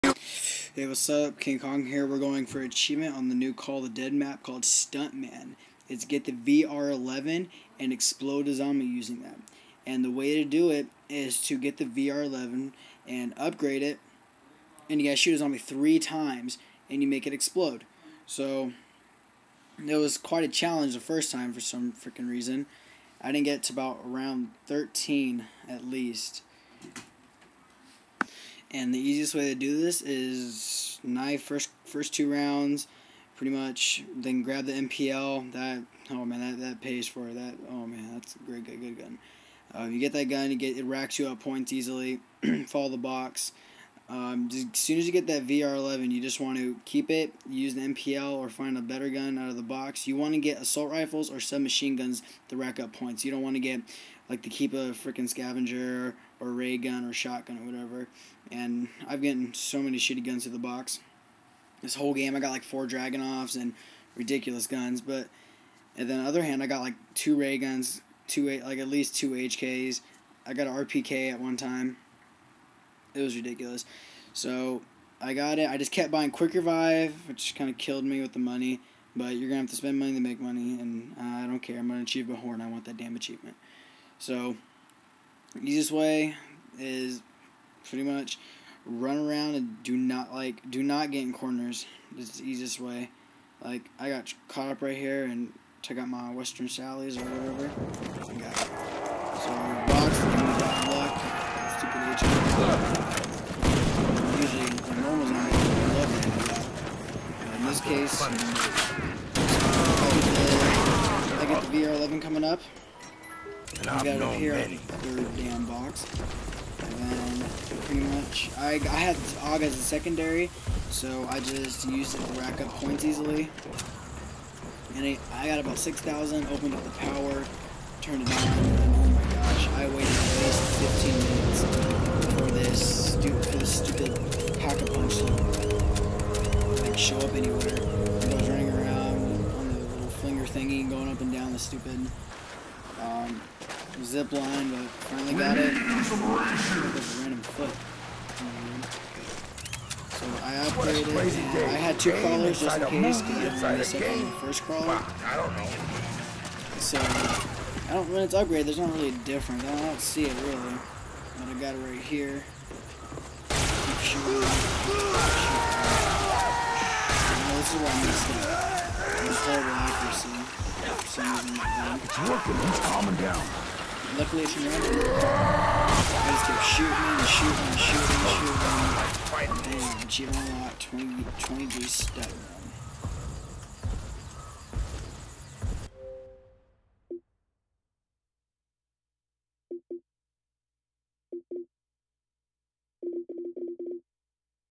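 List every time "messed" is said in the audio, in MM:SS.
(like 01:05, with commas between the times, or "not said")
02:33.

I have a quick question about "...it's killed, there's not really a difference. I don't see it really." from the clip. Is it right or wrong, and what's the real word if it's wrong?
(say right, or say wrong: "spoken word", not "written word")
wrong: "upgraded", not "killed".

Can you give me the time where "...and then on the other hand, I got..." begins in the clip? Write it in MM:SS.
01:05.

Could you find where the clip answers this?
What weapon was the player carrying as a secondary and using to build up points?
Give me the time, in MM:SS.
01:59.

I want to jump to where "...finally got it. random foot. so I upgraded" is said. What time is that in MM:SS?
02:25.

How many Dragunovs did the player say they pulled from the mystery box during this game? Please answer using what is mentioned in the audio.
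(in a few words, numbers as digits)
4.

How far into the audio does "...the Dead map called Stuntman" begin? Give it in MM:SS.
00:03.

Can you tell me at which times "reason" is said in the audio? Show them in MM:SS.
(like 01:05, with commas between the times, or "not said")
00:22, 02:51.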